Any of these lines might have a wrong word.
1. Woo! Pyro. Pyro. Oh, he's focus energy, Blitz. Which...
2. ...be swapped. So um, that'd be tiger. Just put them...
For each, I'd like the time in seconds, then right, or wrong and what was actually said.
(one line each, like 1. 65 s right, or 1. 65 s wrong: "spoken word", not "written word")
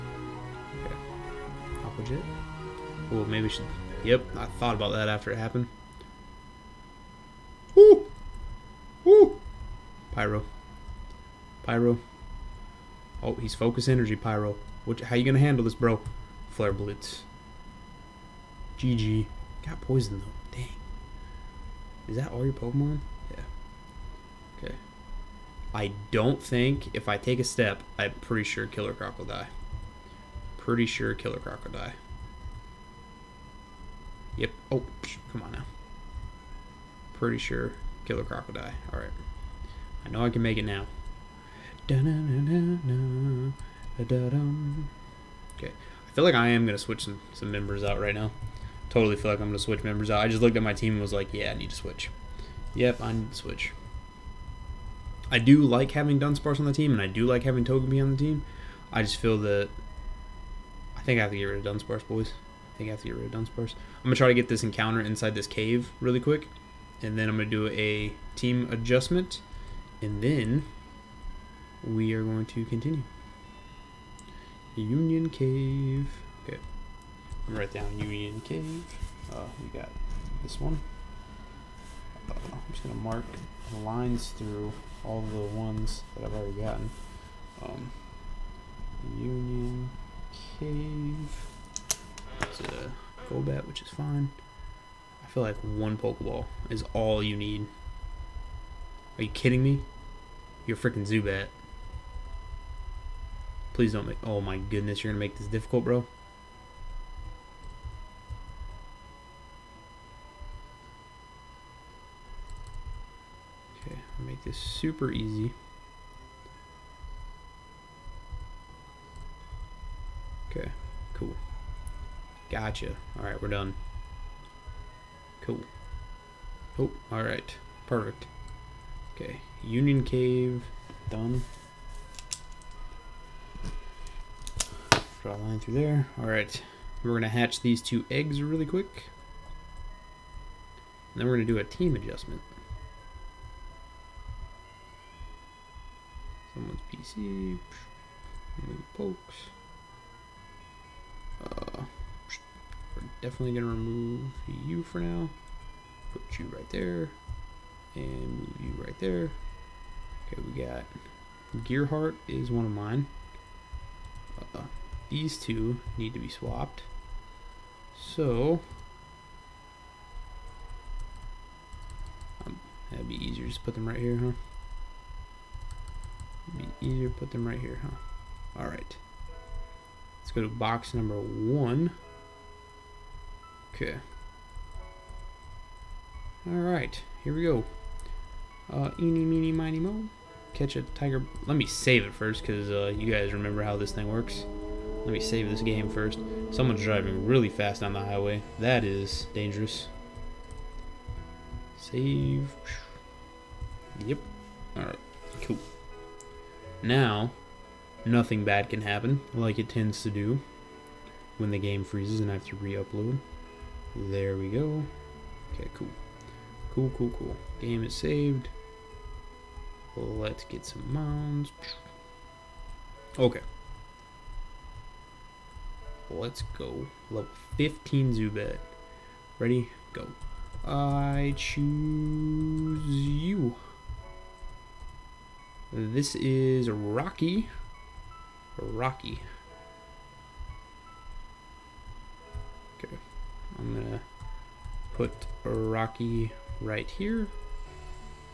1. 9 s wrong: "Pyro", not "Blitz"
2. 166 s wrong: "easier", not "tiger".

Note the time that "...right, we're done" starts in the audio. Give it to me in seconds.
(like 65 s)
123 s.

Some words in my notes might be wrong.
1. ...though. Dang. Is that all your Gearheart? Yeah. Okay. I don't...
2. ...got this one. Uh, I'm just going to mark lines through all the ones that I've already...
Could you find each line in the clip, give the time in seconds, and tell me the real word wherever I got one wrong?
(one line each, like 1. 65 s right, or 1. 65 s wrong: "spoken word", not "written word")
1. 20 s wrong: "Pokemon", not "Gearheart"
2. 79 s right.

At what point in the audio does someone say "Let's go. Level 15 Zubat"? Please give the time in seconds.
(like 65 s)
226 s.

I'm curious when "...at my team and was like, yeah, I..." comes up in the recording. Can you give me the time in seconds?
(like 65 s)
50 s.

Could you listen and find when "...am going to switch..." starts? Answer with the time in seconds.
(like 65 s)
46 s.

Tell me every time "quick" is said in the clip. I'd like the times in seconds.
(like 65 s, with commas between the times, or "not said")
66 s, 138 s.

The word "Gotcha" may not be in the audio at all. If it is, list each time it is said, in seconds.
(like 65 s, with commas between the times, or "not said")
122 s.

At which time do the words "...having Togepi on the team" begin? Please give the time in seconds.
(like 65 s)
57 s.